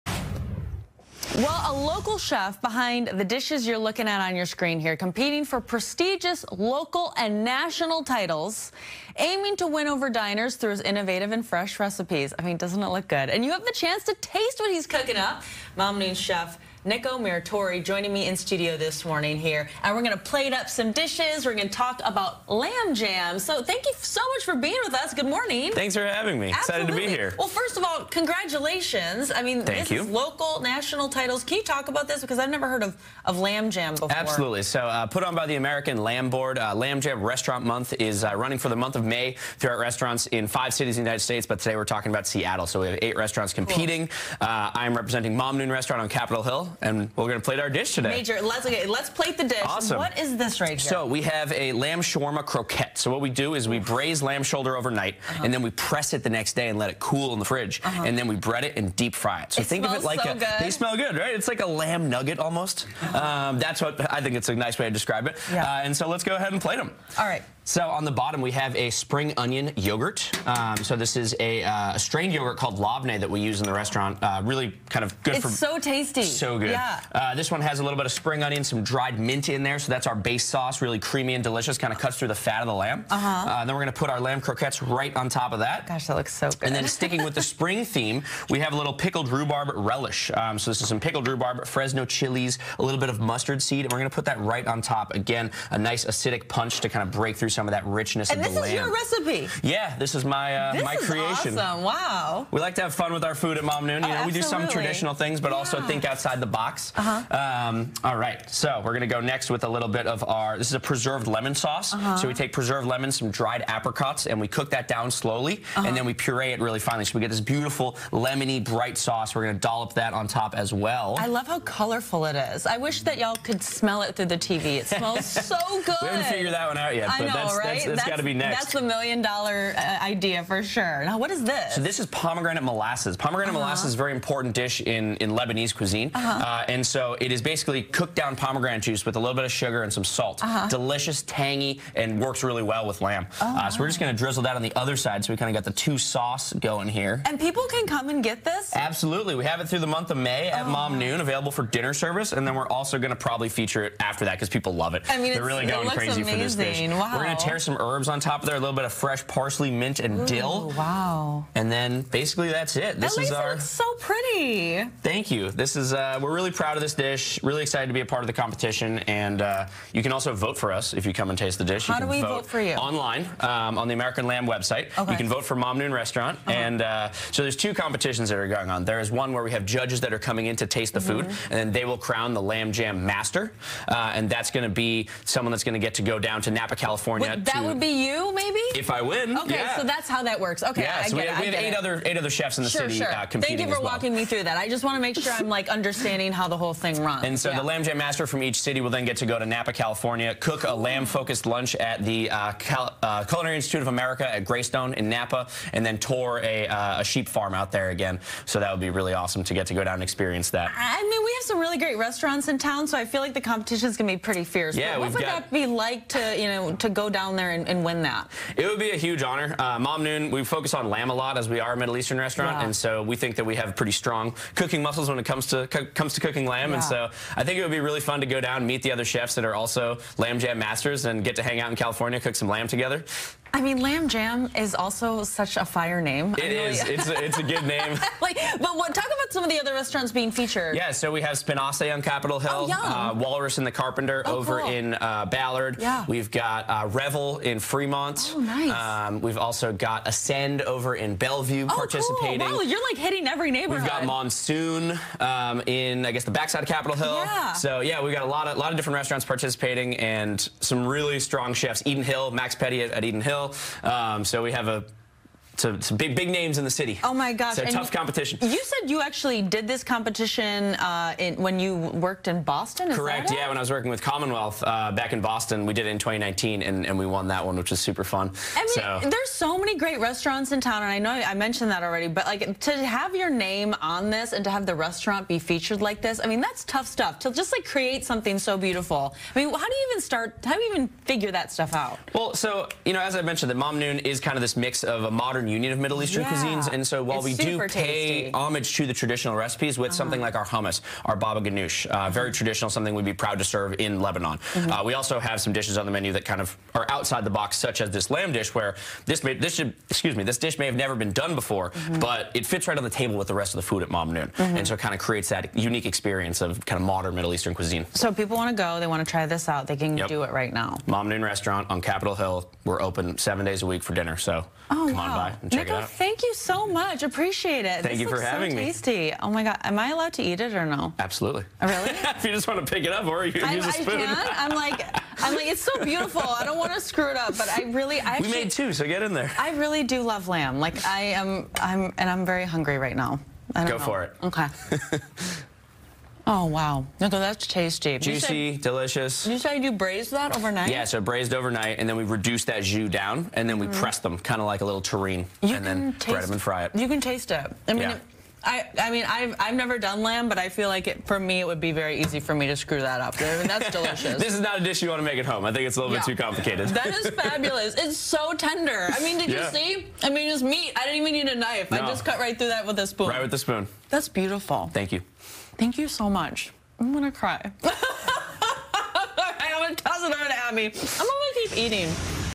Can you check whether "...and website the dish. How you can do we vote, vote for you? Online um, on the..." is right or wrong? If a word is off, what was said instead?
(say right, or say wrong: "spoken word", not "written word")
wrong: "taste", not "website".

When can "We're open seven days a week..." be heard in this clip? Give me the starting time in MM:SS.
05:22.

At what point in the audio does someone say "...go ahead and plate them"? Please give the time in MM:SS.
01:06.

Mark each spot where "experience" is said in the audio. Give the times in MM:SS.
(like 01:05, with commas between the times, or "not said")
03:30, 05:15.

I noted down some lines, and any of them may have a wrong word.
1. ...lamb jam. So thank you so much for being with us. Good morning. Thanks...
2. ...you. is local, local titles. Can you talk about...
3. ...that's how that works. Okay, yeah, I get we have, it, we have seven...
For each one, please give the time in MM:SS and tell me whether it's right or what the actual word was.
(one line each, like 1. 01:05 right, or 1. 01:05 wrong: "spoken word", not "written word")
1. 00:22 right
2. 00:29 wrong: "national", not "local"
3. 03:09 wrong: "eight", not "seven".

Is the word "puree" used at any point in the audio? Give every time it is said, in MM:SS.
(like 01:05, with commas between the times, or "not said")
01:56.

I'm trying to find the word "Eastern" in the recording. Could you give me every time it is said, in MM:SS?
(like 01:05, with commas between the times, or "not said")
03:41, 04:56, 05:17.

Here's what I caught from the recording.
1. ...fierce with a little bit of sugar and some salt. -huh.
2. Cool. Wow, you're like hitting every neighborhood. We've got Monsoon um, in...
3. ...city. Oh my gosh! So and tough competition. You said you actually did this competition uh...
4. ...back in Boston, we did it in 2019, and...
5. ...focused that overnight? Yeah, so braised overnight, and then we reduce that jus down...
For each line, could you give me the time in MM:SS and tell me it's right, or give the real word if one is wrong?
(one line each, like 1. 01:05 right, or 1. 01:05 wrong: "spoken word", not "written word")
1. 02:18 wrong: "juice", not "fierce"
2. 04:12 right
3. 04:26 right
4. 04:34 right
5. 05:49 wrong: "braised", not "focused".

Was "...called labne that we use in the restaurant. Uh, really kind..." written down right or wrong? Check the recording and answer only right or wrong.
right.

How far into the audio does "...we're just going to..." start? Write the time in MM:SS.
02:23.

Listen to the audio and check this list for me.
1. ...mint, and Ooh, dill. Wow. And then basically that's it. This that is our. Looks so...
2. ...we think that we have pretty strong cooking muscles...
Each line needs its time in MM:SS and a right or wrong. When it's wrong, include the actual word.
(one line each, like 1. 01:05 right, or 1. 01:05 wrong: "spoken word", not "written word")
1. 02:39 right
2. 03:43 right.